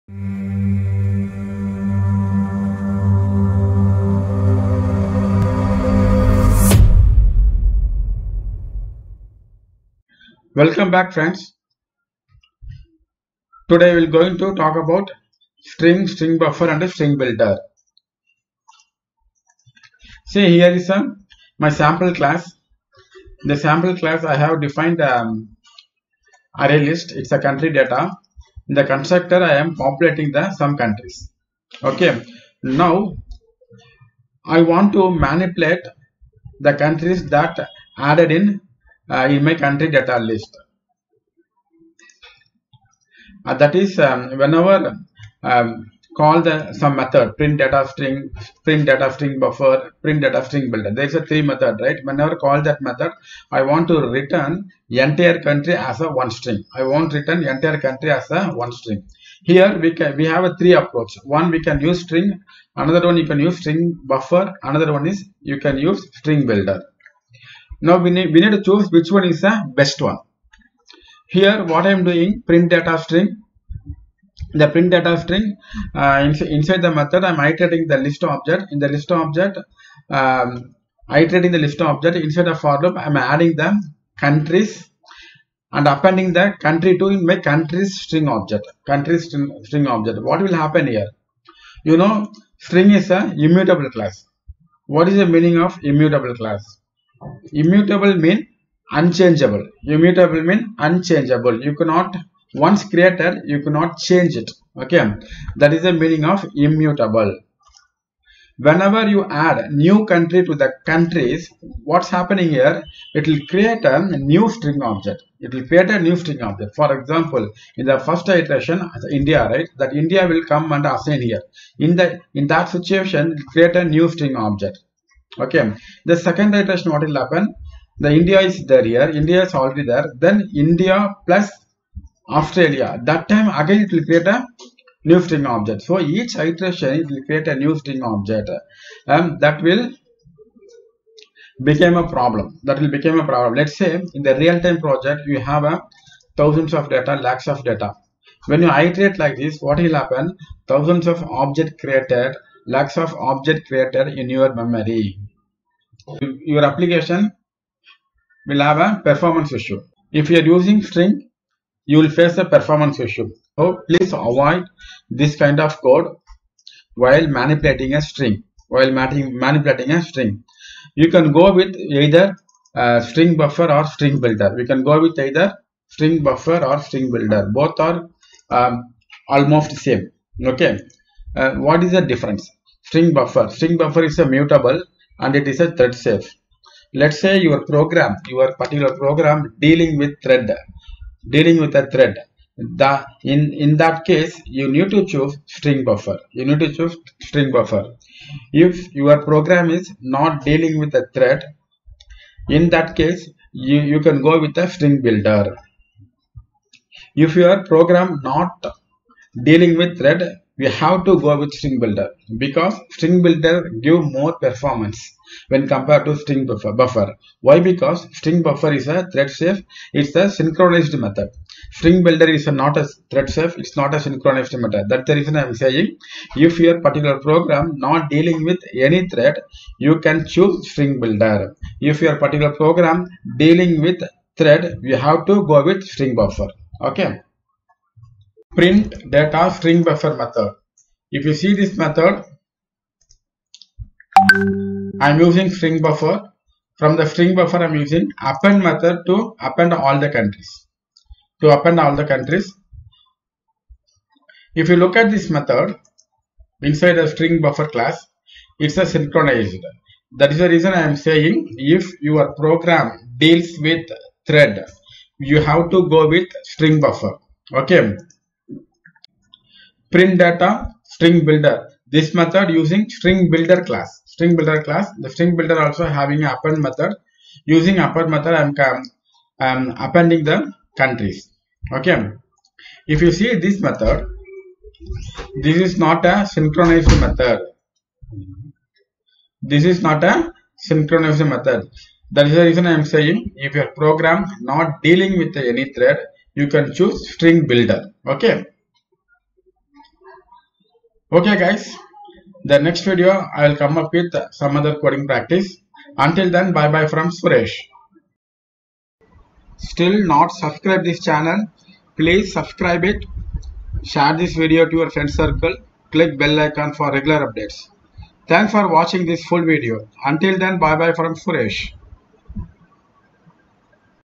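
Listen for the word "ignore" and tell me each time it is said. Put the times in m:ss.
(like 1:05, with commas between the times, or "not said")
not said.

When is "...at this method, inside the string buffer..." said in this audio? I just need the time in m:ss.
4:14.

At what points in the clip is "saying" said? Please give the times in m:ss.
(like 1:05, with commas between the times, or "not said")
3:45, 4:20, 4:52.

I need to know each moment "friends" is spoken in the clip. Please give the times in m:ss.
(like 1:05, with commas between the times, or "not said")
0:11, 5:14.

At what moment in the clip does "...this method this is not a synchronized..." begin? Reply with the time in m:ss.
4:43.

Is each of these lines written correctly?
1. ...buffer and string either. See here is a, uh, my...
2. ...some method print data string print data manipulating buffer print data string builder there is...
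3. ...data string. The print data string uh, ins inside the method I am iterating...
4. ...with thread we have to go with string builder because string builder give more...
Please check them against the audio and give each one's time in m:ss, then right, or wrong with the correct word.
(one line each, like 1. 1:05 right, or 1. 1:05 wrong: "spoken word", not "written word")
1. 0:16 wrong: "builder", not "either"
2. 0:46 wrong: "string", not "manipulating"
3. 1:12 right
4. 3:29 right.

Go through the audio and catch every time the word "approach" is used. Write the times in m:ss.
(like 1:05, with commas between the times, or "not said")
1:00.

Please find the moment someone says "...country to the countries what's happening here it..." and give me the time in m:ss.
1:50.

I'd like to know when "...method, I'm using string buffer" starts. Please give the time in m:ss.
4:01.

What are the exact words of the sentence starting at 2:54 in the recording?
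We can go with either string buffer or string builder.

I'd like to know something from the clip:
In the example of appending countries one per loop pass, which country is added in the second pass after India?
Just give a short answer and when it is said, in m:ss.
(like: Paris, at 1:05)
Australia, at 2:12.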